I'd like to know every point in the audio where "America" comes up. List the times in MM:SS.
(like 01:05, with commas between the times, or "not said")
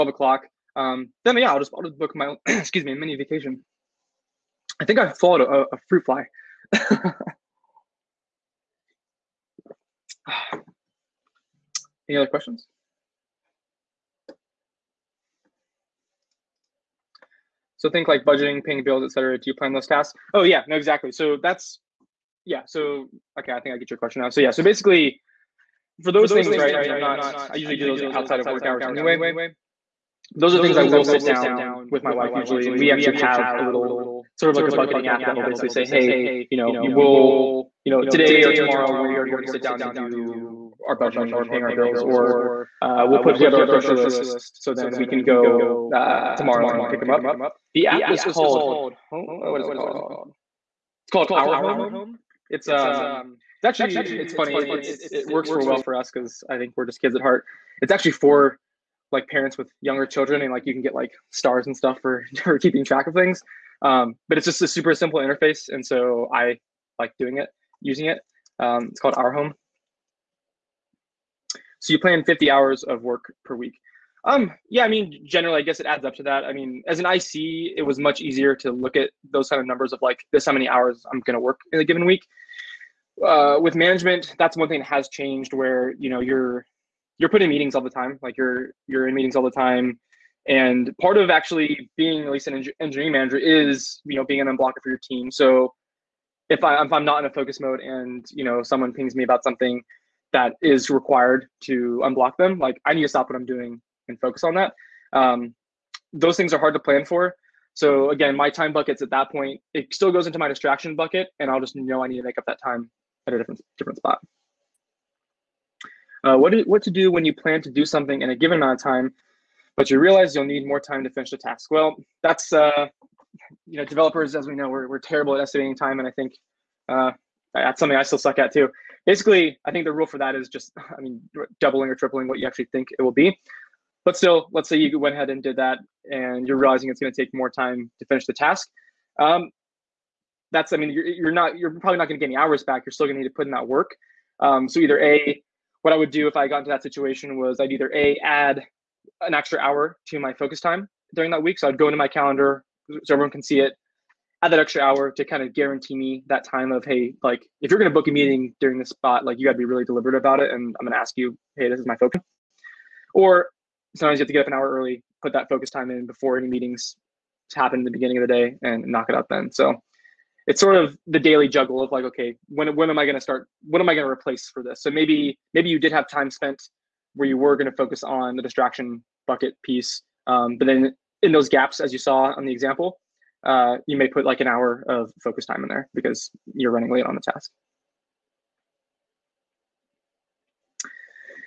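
not said.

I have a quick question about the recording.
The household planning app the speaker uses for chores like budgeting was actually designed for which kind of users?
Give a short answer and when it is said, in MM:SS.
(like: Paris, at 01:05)
parents with younger children, at 00:59.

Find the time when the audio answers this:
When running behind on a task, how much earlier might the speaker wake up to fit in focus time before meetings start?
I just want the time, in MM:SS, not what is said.
02:44.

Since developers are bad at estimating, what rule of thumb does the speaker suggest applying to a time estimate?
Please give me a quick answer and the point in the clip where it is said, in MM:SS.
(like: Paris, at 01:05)
doubling or tripling, at 02:11.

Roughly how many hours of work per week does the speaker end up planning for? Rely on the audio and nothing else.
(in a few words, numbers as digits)
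50 hours.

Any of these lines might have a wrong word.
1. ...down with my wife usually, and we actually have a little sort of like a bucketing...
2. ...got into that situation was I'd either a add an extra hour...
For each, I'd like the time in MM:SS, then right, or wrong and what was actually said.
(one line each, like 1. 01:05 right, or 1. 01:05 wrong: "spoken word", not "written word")
1. 00:31 right
2. 02:26 right.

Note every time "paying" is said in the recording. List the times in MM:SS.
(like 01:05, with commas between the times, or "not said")
00:18, 00:41.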